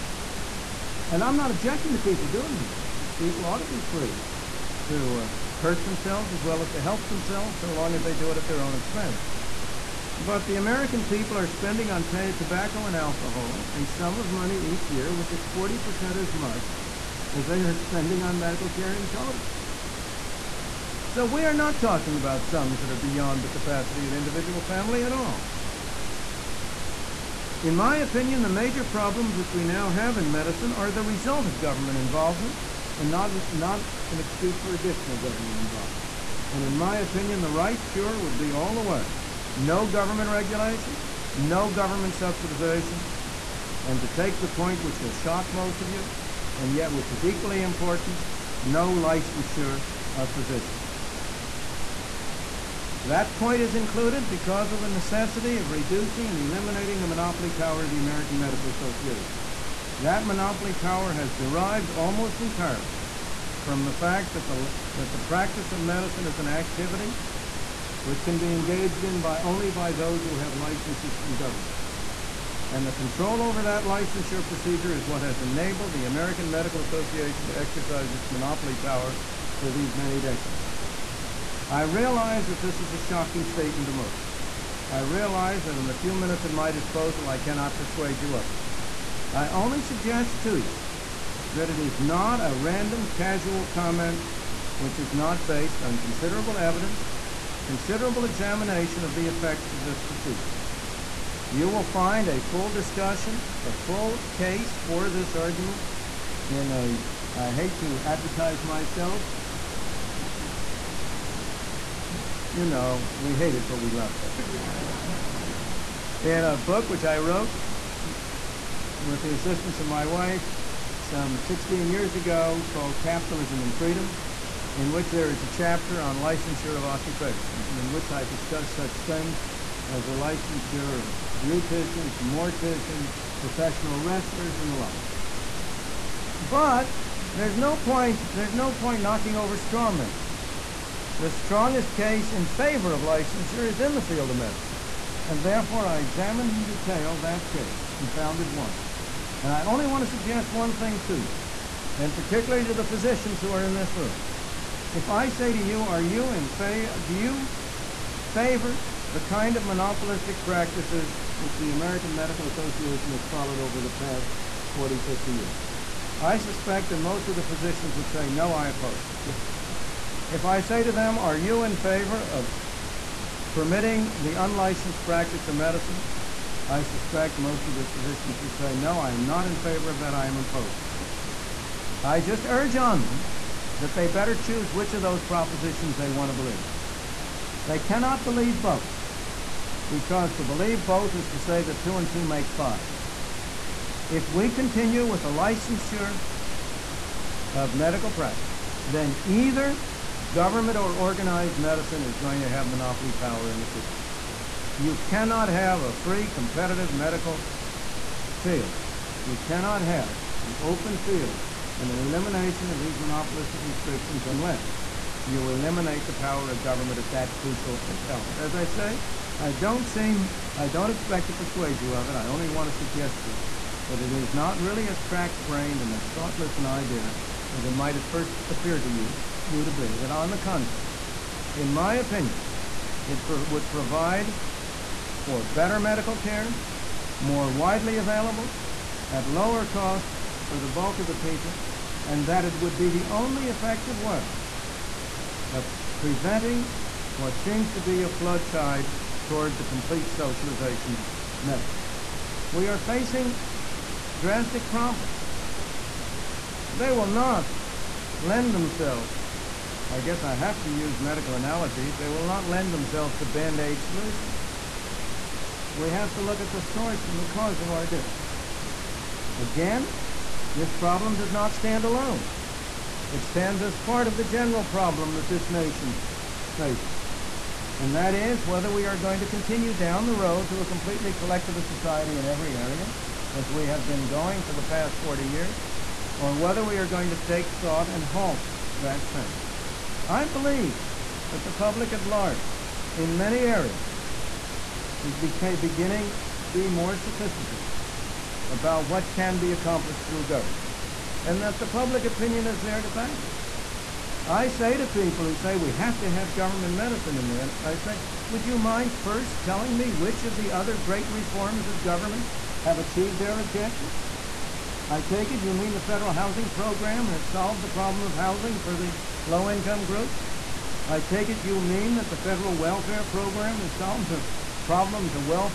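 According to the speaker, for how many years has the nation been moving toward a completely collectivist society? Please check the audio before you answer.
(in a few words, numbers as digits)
40 years.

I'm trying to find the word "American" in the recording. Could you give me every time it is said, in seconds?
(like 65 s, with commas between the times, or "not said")
10 s, 57 s, 76 s, 161 s.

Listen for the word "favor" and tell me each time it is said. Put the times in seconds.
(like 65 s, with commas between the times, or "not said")
142 s, 158 s, 171 s, 179 s.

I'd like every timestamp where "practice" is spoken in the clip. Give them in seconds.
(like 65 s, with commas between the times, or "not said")
65 s, 160 s, 175 s, 198 s.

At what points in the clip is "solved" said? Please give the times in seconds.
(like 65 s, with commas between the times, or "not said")
317 s, 323 s.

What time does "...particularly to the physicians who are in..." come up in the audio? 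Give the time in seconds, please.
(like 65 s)
152 s.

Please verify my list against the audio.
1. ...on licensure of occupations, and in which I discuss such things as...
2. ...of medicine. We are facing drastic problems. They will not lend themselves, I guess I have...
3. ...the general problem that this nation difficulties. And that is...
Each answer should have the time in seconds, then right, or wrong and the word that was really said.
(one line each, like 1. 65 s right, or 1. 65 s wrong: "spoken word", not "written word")
1. 126 s right
2. 250 s right
3. 274 s wrong: "faces", not "difficulties".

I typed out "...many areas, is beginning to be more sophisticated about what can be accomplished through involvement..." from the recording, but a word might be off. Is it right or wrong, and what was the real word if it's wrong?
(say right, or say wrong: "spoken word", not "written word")
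wrong: "government", not "involvement".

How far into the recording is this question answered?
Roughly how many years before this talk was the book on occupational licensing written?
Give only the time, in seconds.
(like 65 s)
121 s.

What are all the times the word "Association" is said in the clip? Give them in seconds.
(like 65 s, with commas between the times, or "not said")
58 s, 76 s, 162 s.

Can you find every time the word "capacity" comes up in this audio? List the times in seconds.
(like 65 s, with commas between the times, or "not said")
23 s.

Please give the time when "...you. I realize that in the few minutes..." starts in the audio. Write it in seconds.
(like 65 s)
84 s.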